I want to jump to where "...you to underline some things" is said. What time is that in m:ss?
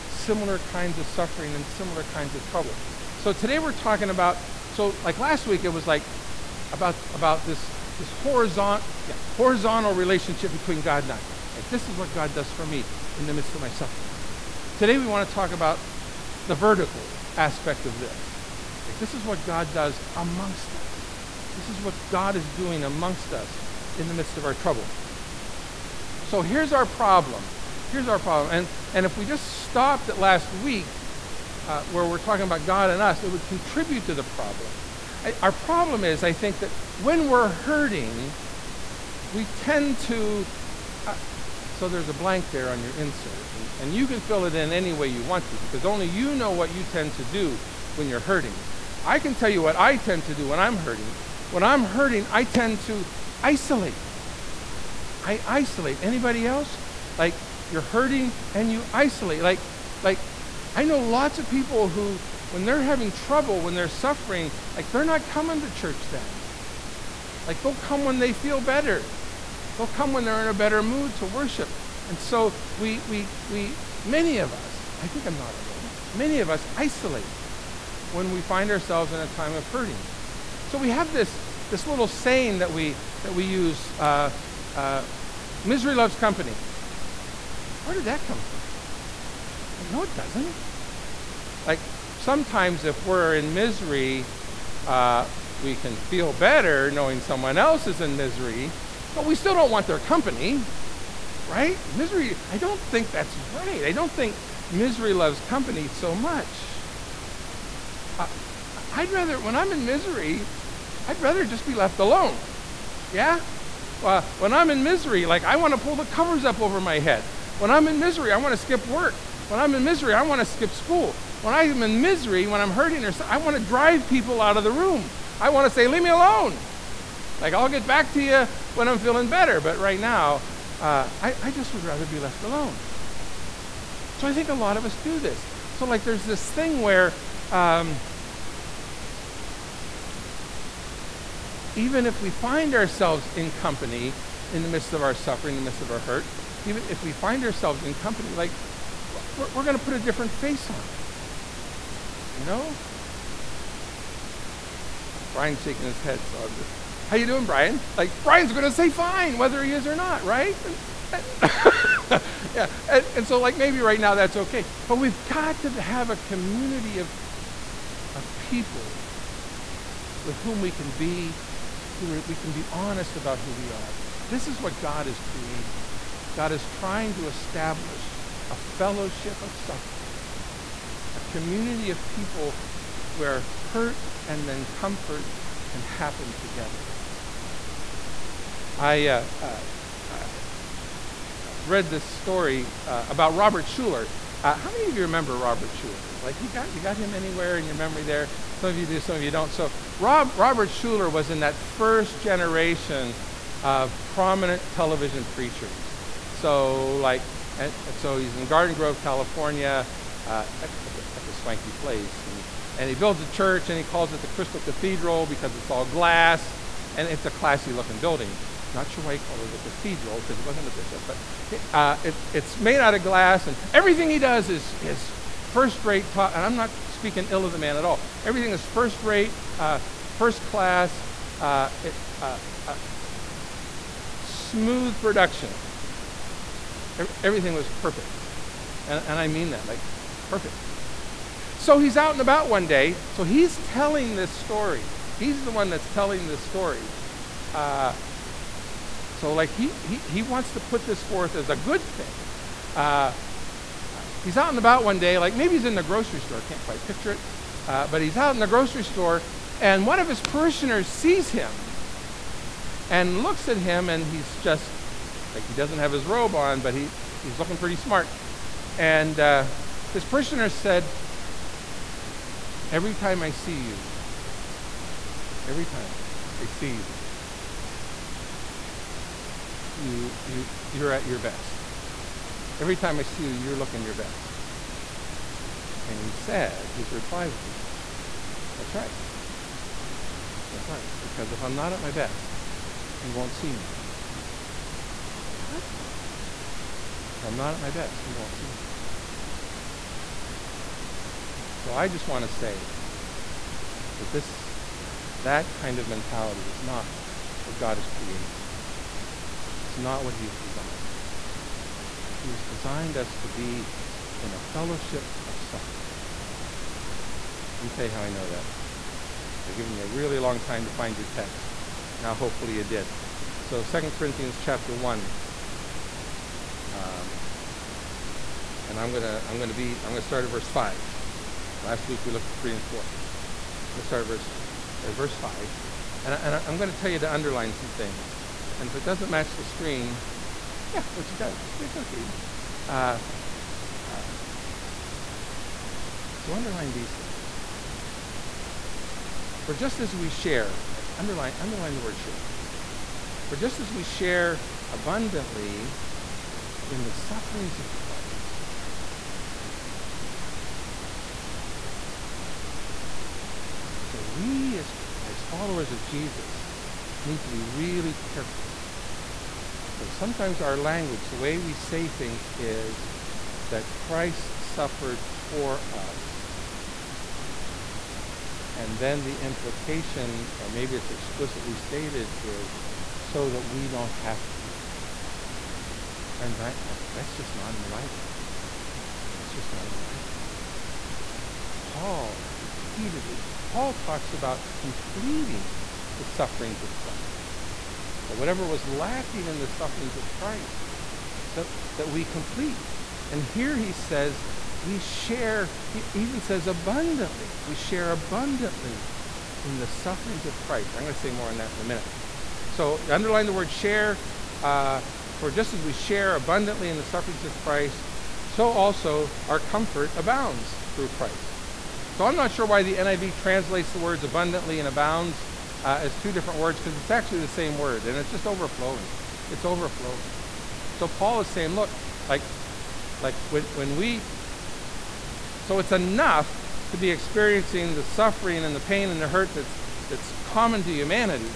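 5:36.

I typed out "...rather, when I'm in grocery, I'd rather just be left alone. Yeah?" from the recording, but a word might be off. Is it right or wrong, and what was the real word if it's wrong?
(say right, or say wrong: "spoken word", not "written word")
wrong: "misery", not "grocery".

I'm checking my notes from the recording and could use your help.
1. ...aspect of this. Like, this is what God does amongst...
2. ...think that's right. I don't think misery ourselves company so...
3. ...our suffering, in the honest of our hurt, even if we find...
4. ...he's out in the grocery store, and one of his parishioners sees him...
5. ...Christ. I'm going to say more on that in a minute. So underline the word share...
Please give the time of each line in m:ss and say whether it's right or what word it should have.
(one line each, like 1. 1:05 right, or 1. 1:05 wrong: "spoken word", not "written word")
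1. 0:17 right
2. 1:42 wrong: "loves", not "ourselves"
3. 2:25 wrong: "midst", not "honest"
4. 4:18 right
5. 6:50 right.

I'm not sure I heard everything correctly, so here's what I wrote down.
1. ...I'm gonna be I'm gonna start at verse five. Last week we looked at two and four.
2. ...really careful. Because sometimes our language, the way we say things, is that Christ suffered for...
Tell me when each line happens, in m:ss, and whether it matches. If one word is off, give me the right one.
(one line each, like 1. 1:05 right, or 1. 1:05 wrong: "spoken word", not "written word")
1. 5:29 wrong: "three", not "two"
2. 6:07 right.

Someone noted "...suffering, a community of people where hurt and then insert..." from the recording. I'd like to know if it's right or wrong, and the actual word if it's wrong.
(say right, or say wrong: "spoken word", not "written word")
wrong: "comfort", not "insert".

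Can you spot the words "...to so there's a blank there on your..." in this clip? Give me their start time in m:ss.
0:40.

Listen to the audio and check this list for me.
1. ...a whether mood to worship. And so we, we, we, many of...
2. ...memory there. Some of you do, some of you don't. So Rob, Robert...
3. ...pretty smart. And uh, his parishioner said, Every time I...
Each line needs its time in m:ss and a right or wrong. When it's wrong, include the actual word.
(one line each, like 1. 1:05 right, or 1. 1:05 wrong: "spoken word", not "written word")
1. 1:10 wrong: "better", not "whether"
2. 3:17 right
3. 4:27 right.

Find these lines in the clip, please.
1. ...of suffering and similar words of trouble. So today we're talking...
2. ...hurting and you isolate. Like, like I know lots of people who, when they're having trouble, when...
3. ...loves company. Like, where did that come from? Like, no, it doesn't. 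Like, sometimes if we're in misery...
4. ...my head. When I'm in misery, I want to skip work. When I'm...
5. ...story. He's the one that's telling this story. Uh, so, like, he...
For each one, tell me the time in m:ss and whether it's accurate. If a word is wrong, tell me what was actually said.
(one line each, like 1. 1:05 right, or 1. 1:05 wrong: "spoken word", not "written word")
1. 0:00 wrong: "kinds", not "words"
2. 0:57 right
3. 1:25 right
4. 1:56 right
5. 4:04 right.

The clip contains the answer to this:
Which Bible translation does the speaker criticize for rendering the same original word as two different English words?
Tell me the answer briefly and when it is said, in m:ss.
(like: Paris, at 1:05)
NIV, at 7:02.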